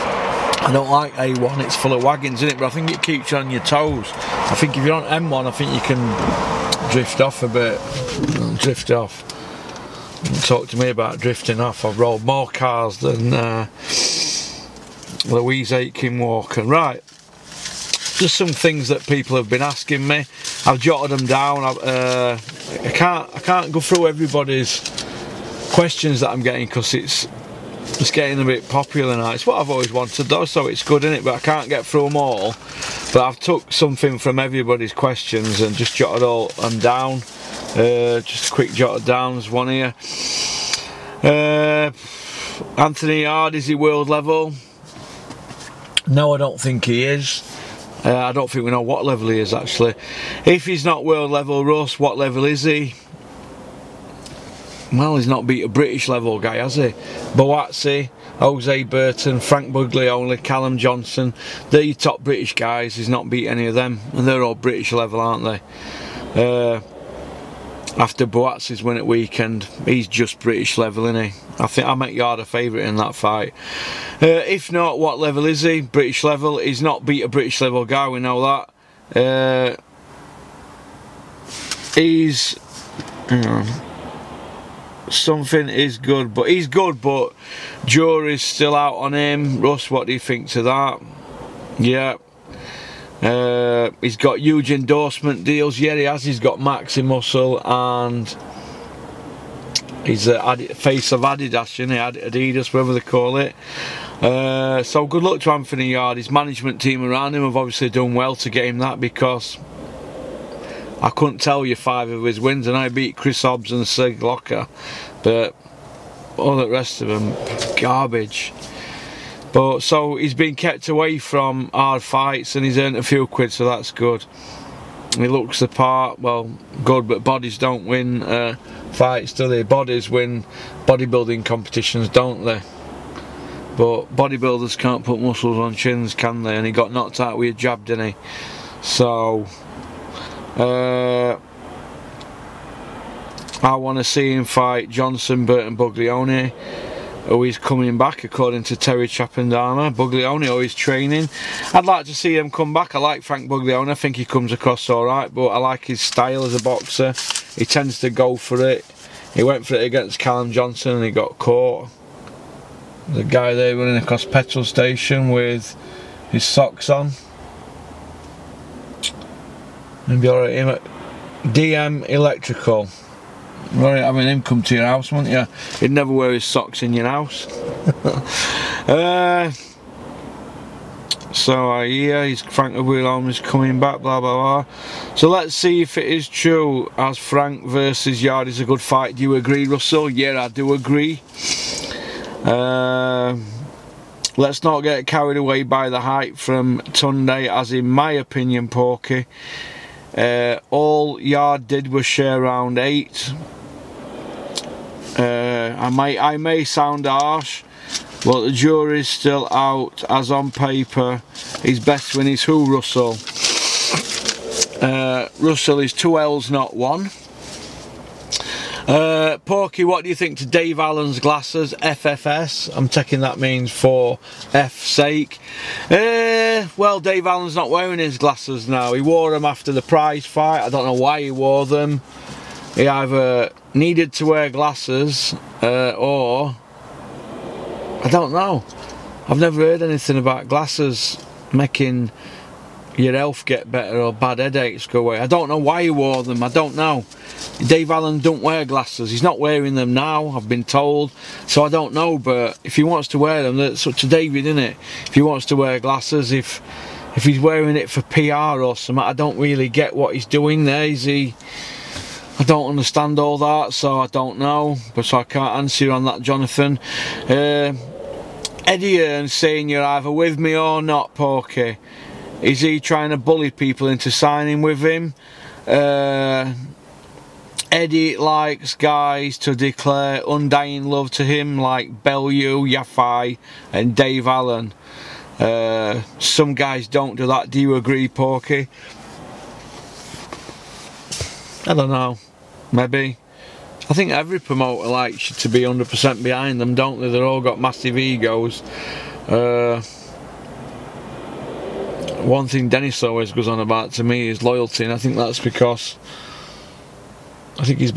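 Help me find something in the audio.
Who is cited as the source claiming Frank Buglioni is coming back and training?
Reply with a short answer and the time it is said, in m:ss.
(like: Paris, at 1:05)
Terry Chapandana, at 2:28.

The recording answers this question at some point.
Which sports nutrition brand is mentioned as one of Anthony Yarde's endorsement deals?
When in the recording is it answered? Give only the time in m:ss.
1:36.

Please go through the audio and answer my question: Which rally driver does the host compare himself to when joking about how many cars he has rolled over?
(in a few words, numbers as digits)
Louise Aitken Walker.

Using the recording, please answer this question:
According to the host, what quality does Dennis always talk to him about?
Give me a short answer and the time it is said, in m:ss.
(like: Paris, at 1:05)
Loyalty, at 5:04.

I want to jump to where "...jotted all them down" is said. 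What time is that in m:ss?
0:35.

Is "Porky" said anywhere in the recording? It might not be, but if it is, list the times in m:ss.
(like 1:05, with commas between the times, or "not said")
3:18, 3:39, 4:31, 4:48.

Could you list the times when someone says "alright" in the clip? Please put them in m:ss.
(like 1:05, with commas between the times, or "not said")
2:34, 2:50.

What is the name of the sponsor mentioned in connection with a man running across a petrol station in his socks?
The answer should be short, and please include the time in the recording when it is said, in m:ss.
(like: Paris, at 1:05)
DM Electrical, at 2:51.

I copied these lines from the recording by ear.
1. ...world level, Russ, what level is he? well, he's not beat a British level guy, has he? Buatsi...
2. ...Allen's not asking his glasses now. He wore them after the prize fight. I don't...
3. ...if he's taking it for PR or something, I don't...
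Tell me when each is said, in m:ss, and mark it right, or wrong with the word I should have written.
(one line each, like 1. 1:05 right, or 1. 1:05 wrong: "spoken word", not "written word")
1. 0:51 right
2. 3:47 wrong: "wearing", not "asking"
3. 4:17 wrong: "wearing", not "taking".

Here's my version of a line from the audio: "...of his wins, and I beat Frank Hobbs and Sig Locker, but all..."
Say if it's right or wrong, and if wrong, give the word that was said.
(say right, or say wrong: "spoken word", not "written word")
wrong: "Chris", not "Frank".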